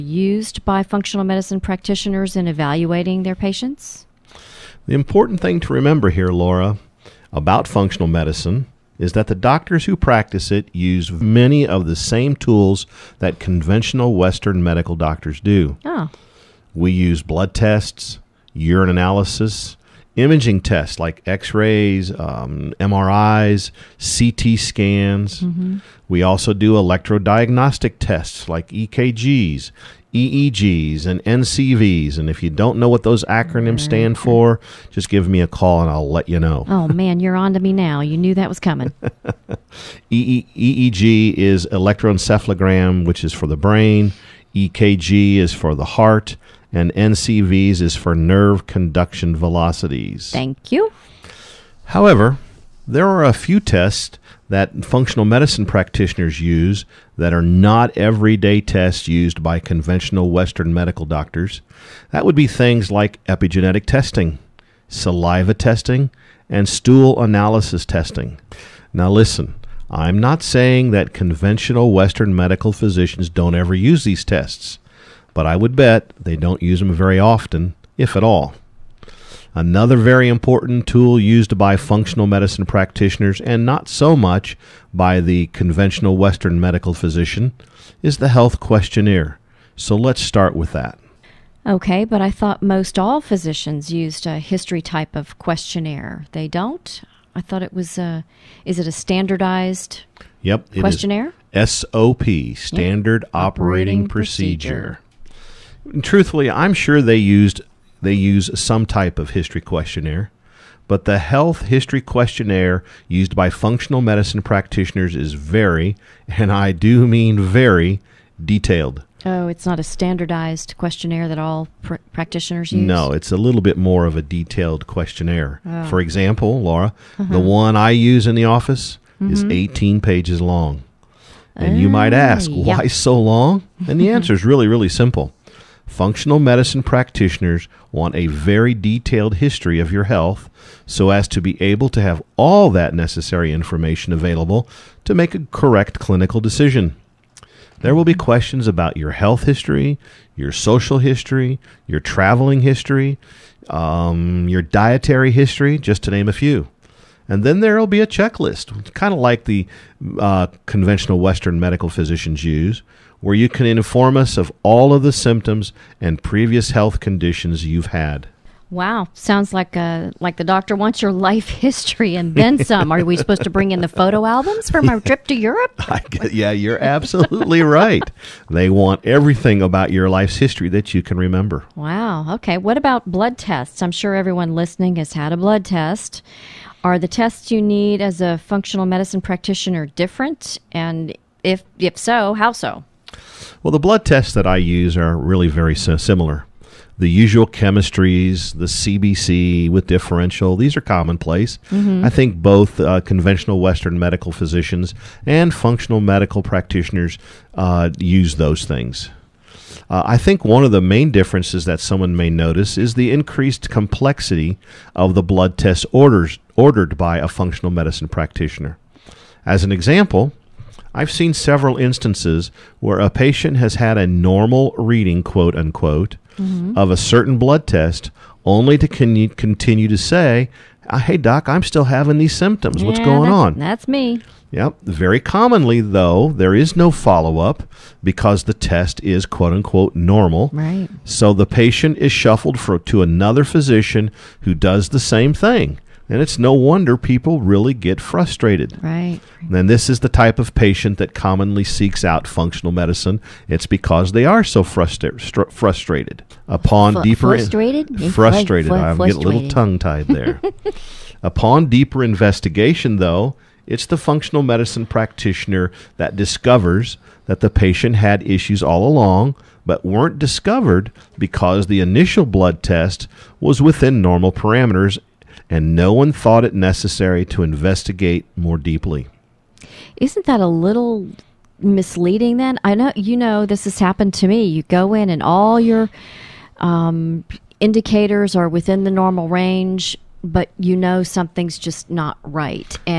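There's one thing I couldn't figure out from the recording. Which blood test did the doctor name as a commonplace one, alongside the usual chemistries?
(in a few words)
CBC with differential.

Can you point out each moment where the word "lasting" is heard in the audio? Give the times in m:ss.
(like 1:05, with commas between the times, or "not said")
not said.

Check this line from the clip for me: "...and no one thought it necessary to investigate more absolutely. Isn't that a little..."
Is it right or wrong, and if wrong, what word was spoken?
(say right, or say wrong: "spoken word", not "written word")
wrong: "deeply", not "absolutely".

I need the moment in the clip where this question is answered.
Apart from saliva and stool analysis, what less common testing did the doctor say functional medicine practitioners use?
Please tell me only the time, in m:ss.
1:03.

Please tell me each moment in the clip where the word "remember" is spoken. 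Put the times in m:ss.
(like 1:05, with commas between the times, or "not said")
0:05, 3:01.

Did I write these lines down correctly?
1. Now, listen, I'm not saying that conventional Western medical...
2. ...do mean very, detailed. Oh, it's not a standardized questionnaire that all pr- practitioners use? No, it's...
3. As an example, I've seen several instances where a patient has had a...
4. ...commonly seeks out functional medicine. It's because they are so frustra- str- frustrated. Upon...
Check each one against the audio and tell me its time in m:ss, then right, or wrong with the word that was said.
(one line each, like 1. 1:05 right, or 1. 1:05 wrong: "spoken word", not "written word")
1. 1:08 right
2. 1:56 right
3. 3:39 right
4. 4:11 right.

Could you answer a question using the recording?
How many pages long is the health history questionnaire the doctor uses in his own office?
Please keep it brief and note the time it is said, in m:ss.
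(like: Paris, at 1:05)
18, at 2:09.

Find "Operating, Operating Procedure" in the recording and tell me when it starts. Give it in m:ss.
1:43.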